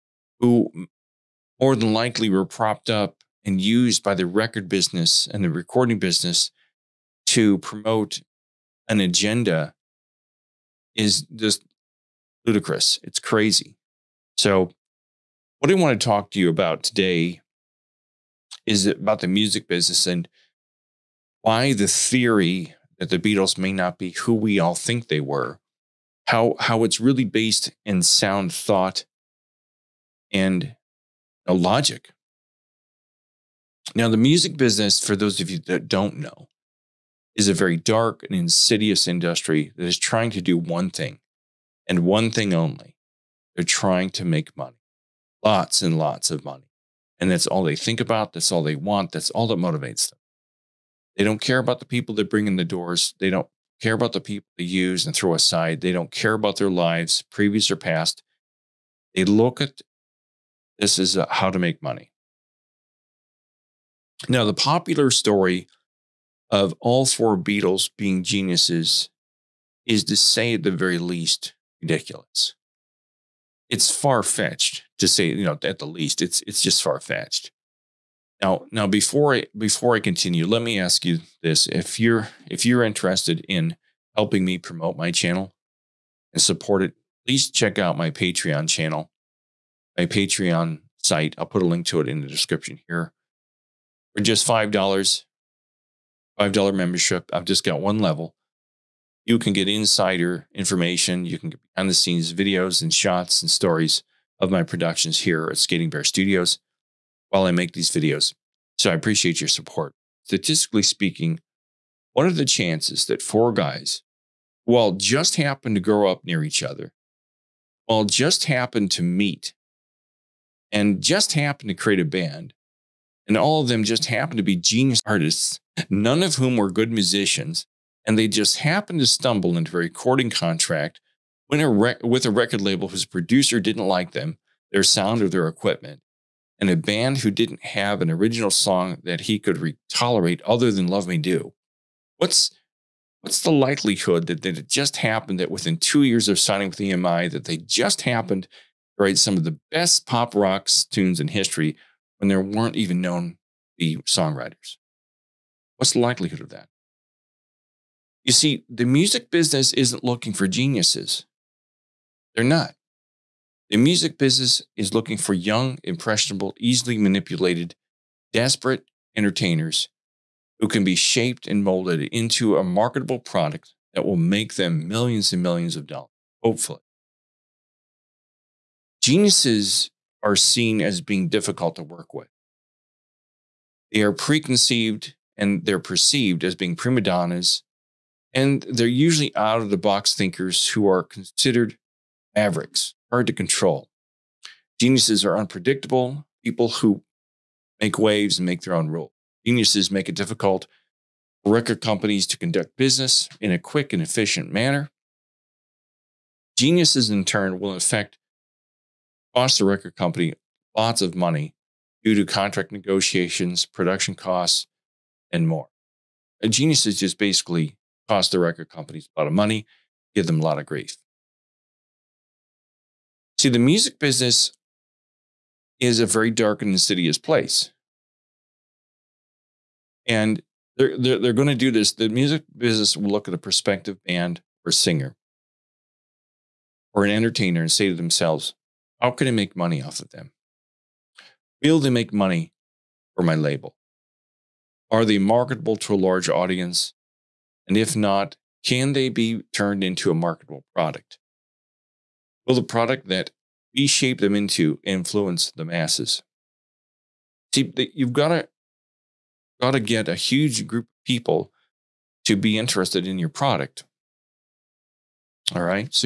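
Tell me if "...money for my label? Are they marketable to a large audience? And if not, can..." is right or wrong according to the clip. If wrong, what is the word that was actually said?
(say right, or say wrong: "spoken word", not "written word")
right.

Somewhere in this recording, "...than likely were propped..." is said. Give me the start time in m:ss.
0:01.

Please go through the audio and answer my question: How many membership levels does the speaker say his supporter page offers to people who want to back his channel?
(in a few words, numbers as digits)
1.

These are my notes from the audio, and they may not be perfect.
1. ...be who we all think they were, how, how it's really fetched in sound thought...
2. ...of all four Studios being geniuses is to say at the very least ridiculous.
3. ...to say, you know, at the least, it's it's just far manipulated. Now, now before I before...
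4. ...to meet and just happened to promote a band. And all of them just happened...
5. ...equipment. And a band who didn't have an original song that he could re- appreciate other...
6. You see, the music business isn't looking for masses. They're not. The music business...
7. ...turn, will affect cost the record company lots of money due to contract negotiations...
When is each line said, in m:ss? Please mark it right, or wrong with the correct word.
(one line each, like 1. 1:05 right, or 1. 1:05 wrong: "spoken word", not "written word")
1. 0:23 wrong: "based", not "fetched"
2. 1:06 wrong: "Beatles", not "Studios"
3. 1:14 wrong: "fetched", not "manipulated"
4. 1:58 wrong: "create", not "promote"
5. 2:15 wrong: "tolerate", not "appreciate"
6. 2:38 wrong: "geniuses", not "masses"
7. 3:27 right.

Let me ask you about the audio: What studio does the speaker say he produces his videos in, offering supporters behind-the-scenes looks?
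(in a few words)
Skating Bear Studios.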